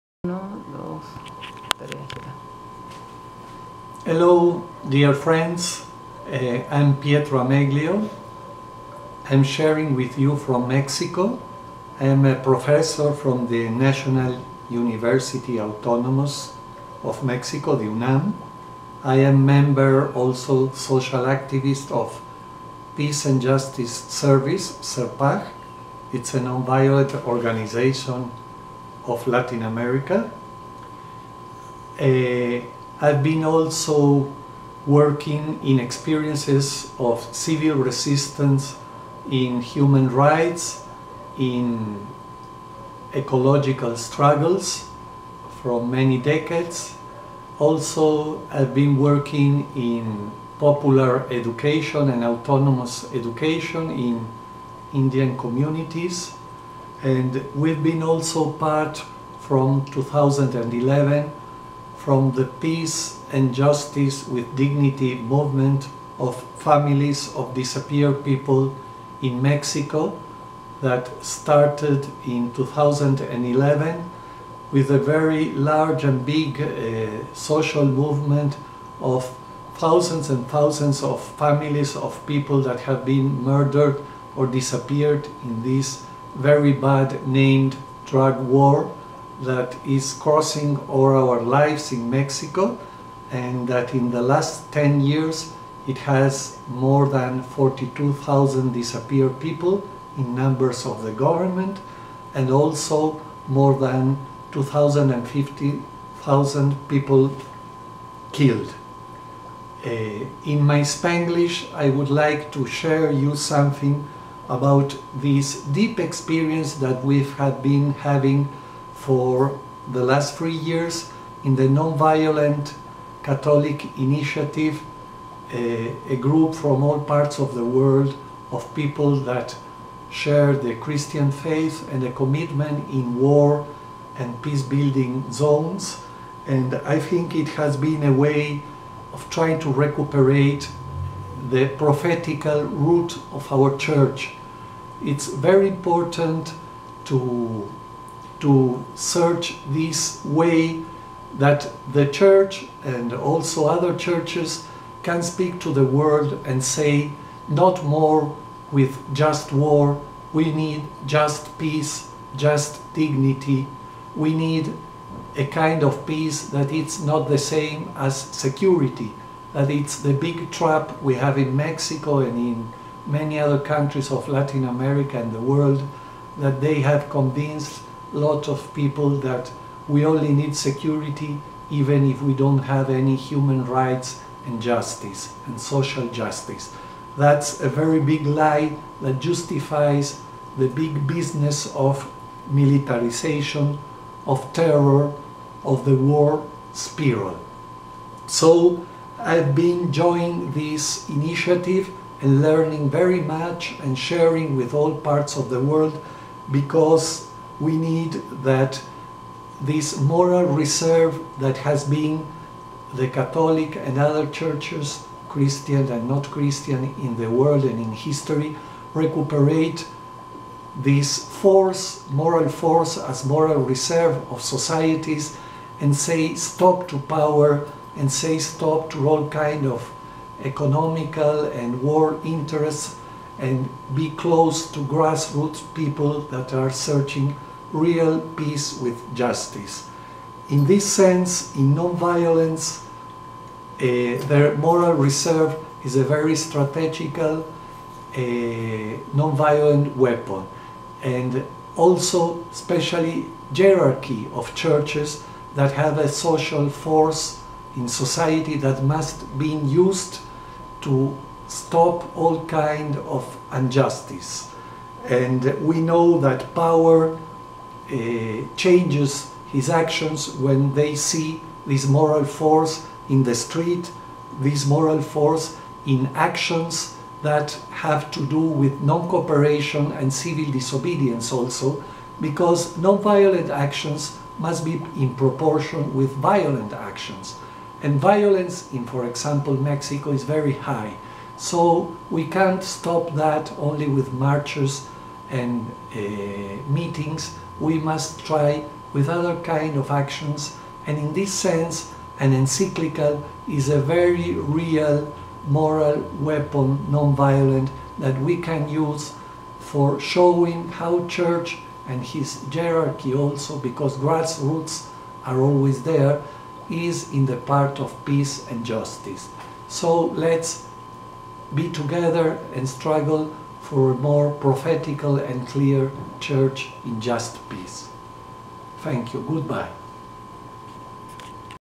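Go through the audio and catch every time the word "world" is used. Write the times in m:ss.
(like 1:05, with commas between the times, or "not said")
2:07, 2:35, 2:55, 3:25, 3:37.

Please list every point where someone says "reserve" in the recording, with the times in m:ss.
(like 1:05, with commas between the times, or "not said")
3:30, 3:43, 4:04.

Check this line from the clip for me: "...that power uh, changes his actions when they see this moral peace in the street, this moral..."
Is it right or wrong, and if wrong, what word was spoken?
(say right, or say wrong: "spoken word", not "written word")
wrong: "force", not "peace".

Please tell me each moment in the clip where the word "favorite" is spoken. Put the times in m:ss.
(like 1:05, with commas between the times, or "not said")
not said.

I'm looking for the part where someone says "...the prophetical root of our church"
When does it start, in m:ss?
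2:21.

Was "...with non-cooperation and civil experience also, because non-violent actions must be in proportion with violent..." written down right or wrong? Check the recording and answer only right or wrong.
wrong.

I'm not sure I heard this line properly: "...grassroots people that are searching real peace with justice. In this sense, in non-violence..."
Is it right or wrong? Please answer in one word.
right.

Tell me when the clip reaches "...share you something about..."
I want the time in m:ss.
1:52.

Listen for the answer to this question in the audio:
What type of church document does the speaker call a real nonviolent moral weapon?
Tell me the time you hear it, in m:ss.
5:02.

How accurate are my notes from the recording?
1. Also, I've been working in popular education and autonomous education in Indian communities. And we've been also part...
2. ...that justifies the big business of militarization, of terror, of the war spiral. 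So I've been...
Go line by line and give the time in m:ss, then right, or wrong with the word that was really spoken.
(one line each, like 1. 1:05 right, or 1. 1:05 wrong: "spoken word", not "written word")
1. 0:47 right
2. 3:09 right.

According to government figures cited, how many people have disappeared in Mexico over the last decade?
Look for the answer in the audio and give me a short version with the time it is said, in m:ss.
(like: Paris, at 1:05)
42,000, at 1:37.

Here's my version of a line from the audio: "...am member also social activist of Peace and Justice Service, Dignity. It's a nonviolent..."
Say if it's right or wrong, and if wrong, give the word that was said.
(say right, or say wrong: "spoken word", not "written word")
wrong: "SERPAJ", not "Dignity".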